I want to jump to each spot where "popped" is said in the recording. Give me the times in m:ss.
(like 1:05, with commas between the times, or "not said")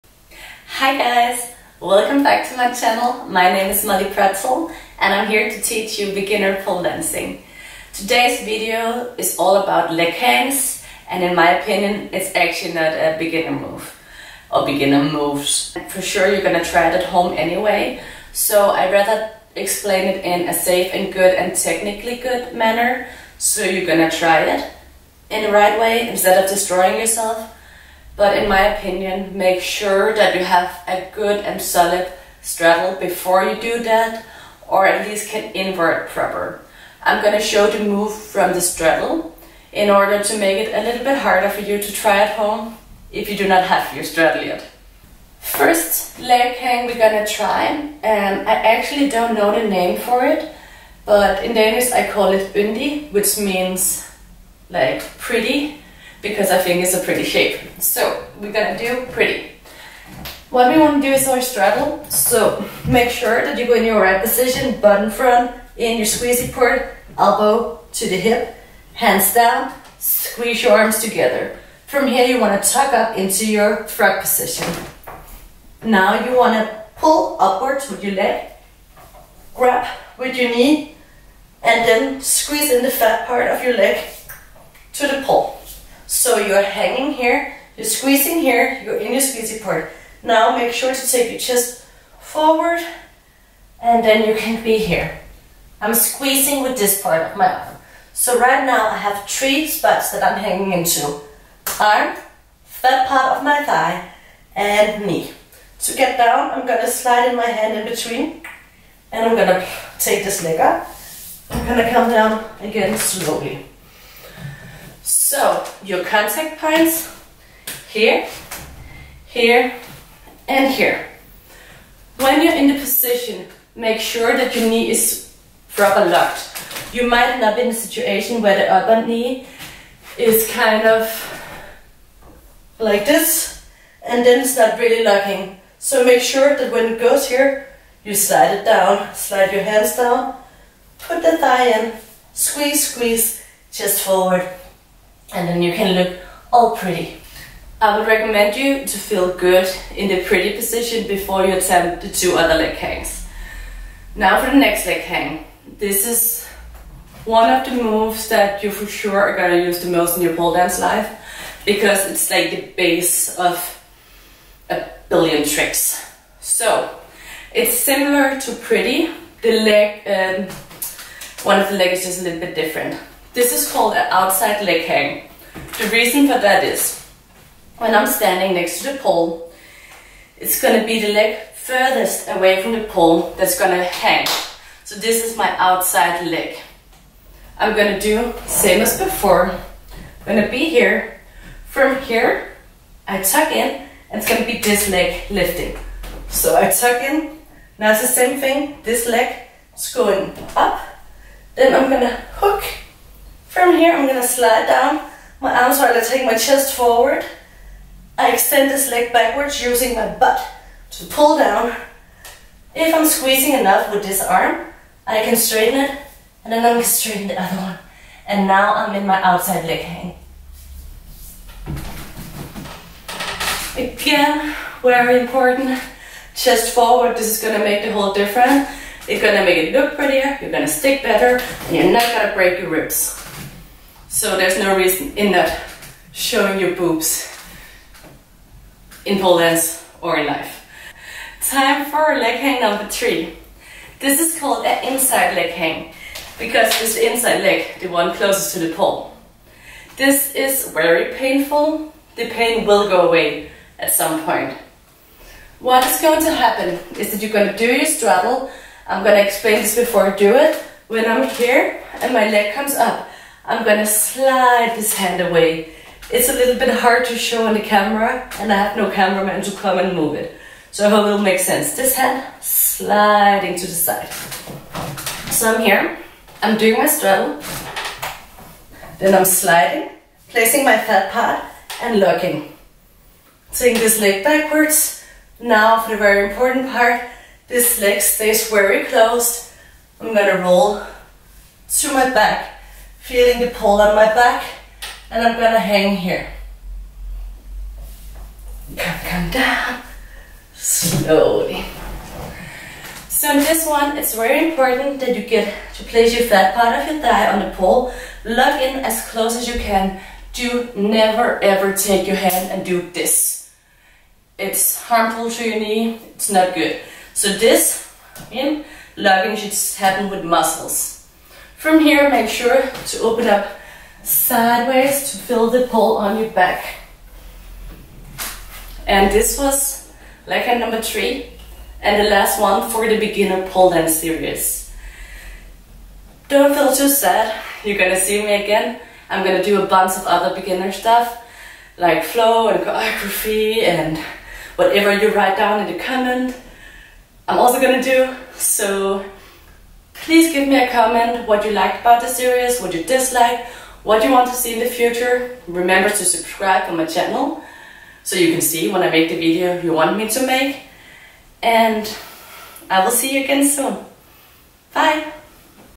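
not said.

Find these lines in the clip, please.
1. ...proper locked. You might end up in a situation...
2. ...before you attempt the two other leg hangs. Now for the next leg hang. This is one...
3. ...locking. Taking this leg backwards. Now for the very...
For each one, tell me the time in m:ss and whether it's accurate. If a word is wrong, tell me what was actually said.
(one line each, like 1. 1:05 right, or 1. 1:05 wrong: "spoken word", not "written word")
1. 2:05 right
2. 2:31 right
3. 4:41 right.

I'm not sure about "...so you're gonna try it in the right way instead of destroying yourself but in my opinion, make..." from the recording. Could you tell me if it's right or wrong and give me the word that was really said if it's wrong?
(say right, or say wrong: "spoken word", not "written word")
right.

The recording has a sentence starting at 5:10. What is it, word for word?
Do never ever take your hand and do this.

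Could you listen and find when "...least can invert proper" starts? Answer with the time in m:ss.
0:35.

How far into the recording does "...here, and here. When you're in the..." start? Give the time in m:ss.
1:59.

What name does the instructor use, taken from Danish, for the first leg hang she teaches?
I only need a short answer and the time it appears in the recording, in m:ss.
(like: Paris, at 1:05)
Yndi, at 0:52.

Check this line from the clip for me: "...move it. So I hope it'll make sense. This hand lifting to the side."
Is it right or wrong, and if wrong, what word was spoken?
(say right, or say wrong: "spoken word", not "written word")
wrong: "sliding", not "lifting".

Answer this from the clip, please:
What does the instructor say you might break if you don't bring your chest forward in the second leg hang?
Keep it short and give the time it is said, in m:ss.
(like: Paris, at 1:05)
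Ribs, at 3:52.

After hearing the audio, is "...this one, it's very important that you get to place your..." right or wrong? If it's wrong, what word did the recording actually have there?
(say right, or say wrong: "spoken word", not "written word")
right.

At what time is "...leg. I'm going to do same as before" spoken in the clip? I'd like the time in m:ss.
3:06.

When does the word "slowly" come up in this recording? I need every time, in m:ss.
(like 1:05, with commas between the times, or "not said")
1:52, 5:00.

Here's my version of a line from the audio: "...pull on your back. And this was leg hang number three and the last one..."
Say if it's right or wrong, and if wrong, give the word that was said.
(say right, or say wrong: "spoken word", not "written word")
right.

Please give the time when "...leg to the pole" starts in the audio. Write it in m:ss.
1:23.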